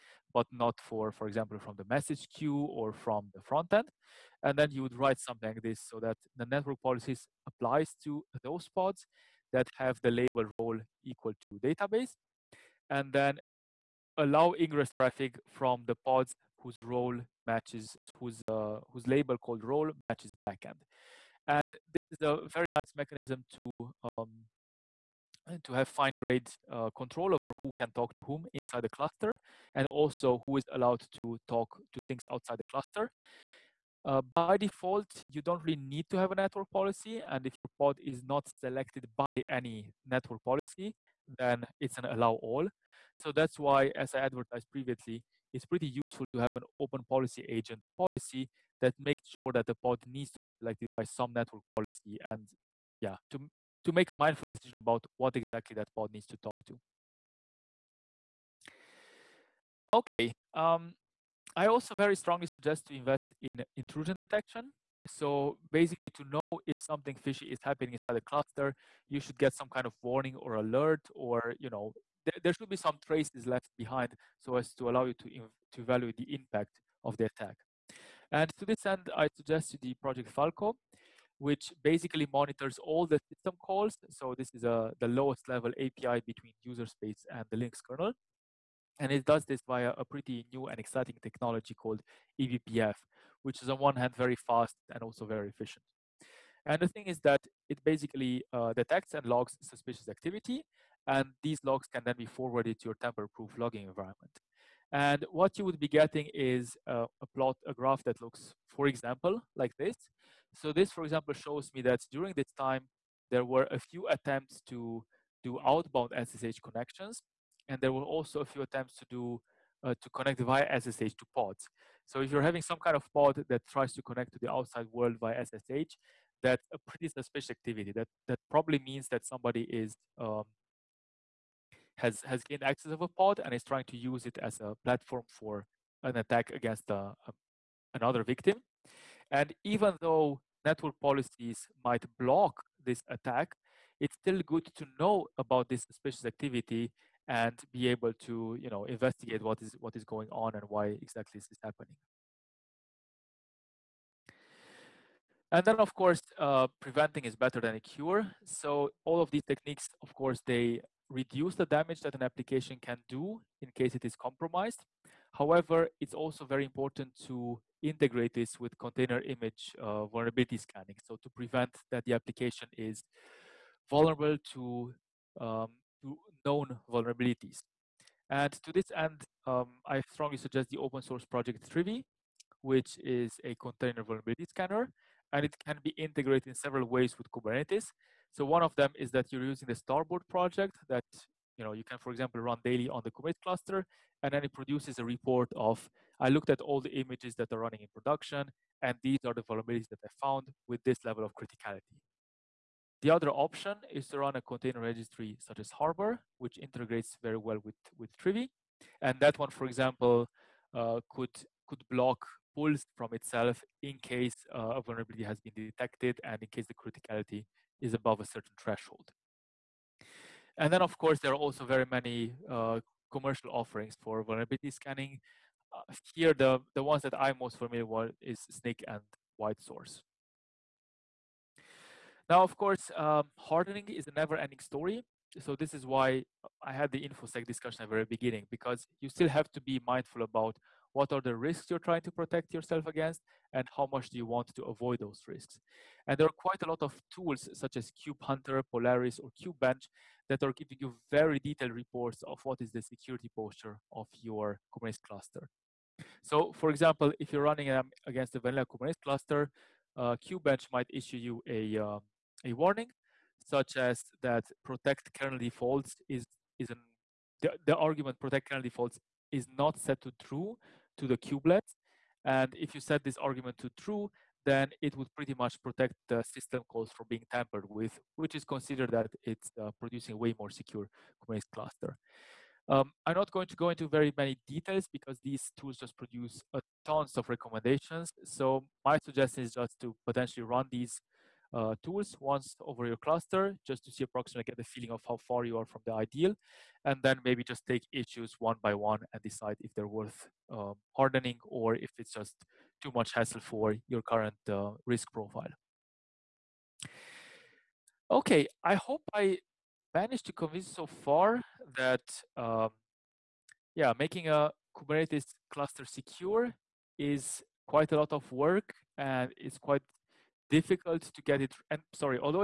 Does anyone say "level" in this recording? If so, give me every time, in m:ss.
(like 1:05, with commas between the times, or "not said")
1:25, 3:21.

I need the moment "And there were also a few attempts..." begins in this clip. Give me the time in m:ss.
1:57.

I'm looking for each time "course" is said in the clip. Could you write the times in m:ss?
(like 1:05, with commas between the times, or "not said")
2:35, 2:40, 3:40, 3:52.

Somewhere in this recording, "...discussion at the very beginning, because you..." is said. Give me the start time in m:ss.
3:57.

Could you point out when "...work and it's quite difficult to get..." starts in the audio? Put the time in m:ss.
5:18.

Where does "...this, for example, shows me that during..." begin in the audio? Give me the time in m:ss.
1:50.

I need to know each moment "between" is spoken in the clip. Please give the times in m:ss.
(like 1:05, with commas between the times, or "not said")
1:26.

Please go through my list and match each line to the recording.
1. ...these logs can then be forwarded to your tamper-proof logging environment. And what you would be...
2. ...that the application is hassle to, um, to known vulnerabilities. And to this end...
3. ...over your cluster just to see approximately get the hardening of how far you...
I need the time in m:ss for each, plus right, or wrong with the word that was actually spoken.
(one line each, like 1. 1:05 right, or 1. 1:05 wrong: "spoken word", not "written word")
1. 1:41 right
2. 2:51 wrong: "vulnerable", not "hassle"
3. 4:52 wrong: "feeling", not "hardening".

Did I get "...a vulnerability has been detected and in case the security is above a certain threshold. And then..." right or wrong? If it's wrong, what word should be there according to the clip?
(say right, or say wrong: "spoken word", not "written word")
wrong: "criticality", not "security".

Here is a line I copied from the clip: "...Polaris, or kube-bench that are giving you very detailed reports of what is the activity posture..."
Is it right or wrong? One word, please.
wrong.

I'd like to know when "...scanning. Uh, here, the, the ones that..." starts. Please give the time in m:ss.
3:44.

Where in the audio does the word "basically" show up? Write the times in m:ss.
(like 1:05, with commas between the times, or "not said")
1:05, 1:21, 1:37.